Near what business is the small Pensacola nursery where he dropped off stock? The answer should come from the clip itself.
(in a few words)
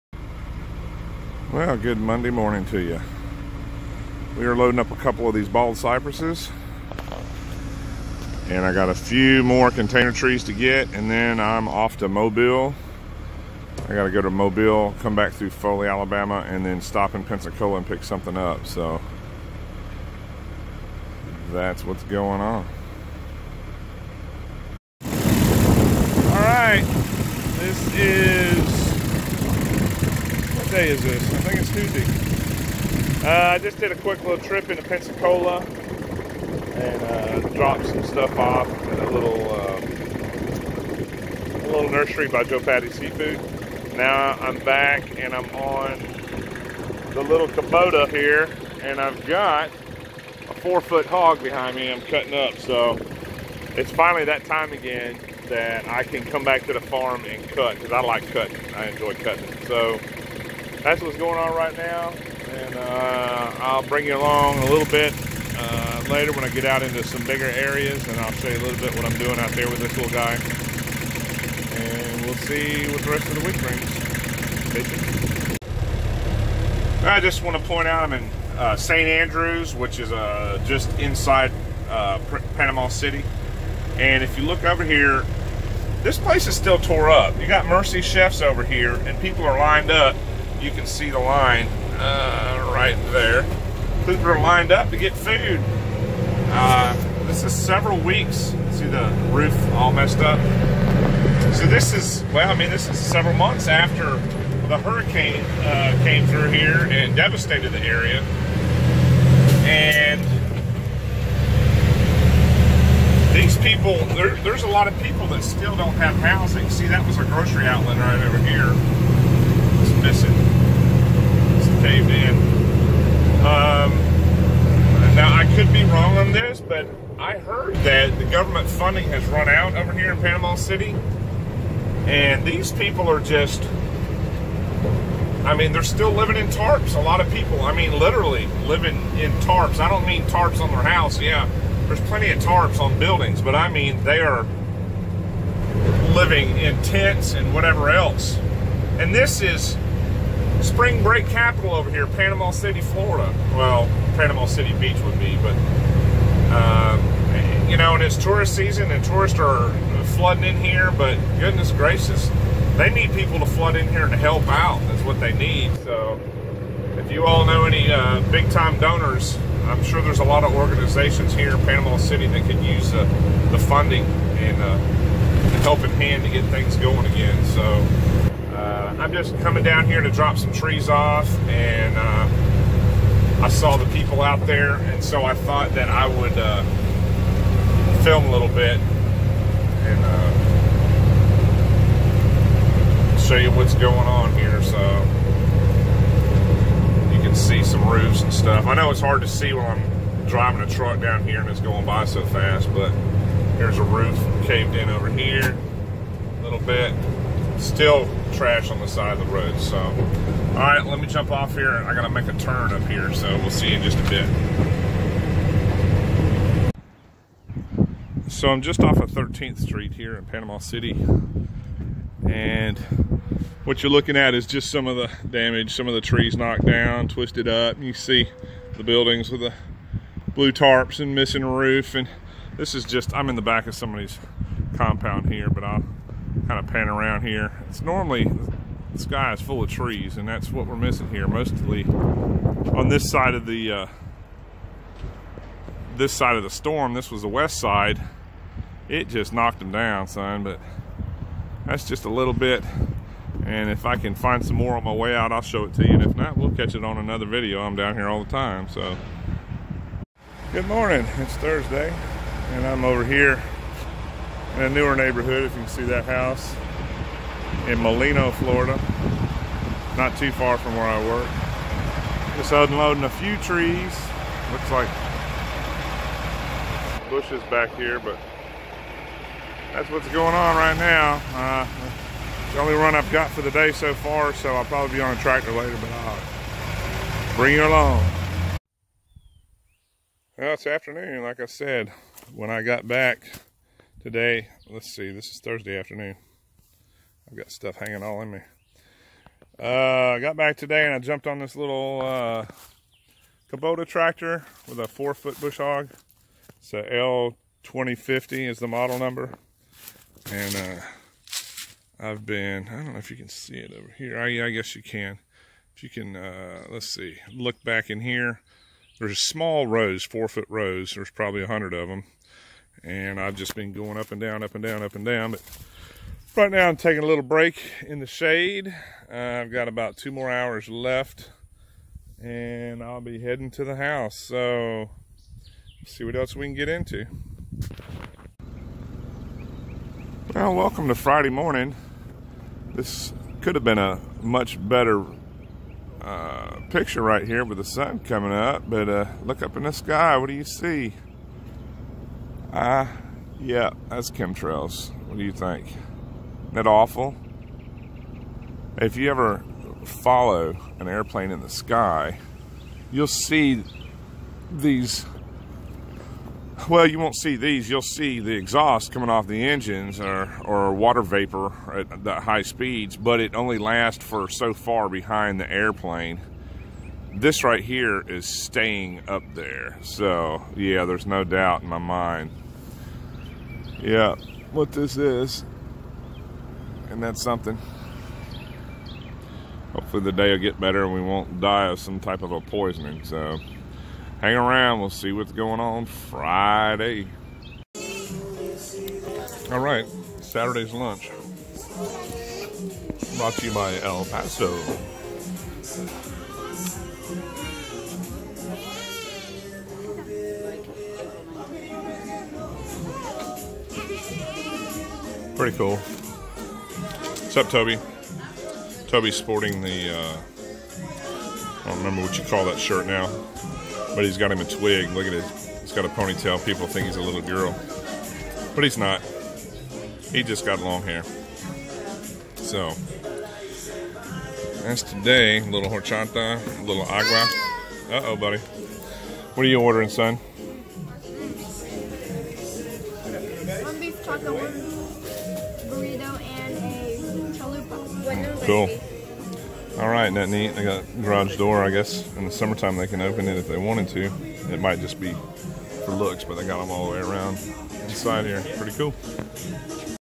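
Joe Patti Seafood.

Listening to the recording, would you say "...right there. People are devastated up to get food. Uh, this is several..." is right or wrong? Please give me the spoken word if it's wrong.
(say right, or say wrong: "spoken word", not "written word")
wrong: "lined", not "devastated".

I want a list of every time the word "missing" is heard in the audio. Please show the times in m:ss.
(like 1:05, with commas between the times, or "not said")
2:00, 3:51, 4:00.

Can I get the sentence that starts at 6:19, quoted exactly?
So yeah, there's no doubt in my mind yeah, what this is.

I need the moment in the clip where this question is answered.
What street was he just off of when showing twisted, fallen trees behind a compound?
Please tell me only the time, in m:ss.
3:39.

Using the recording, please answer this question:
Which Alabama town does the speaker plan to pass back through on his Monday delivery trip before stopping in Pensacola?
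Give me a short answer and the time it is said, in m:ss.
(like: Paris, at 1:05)
Foley, at 0:15.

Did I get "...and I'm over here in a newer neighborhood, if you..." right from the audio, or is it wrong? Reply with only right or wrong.
right.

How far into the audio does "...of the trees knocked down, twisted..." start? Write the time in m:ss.
3:45.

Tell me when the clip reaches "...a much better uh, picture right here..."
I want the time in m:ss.
5:43.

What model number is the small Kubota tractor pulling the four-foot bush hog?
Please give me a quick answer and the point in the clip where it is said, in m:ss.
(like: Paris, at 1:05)
L2050, at 5:06.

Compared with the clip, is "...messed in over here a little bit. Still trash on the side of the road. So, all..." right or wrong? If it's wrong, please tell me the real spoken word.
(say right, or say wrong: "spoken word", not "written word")
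wrong: "caved", not "messed".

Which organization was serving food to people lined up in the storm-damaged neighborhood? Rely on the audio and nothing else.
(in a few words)
Mercy Chefs.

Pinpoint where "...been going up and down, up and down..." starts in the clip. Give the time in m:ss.
5:23.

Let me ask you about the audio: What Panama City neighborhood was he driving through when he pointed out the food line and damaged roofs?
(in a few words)
St. Andrews.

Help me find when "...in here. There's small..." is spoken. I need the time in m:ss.
5:17.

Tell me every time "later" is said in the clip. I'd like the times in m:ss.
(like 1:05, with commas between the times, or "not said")
1:06, 4:45.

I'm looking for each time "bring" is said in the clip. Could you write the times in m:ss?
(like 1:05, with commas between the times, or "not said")
1:03, 1:13, 4:47.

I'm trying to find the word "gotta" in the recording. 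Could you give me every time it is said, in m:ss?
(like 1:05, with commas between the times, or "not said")
0:13, 3:31.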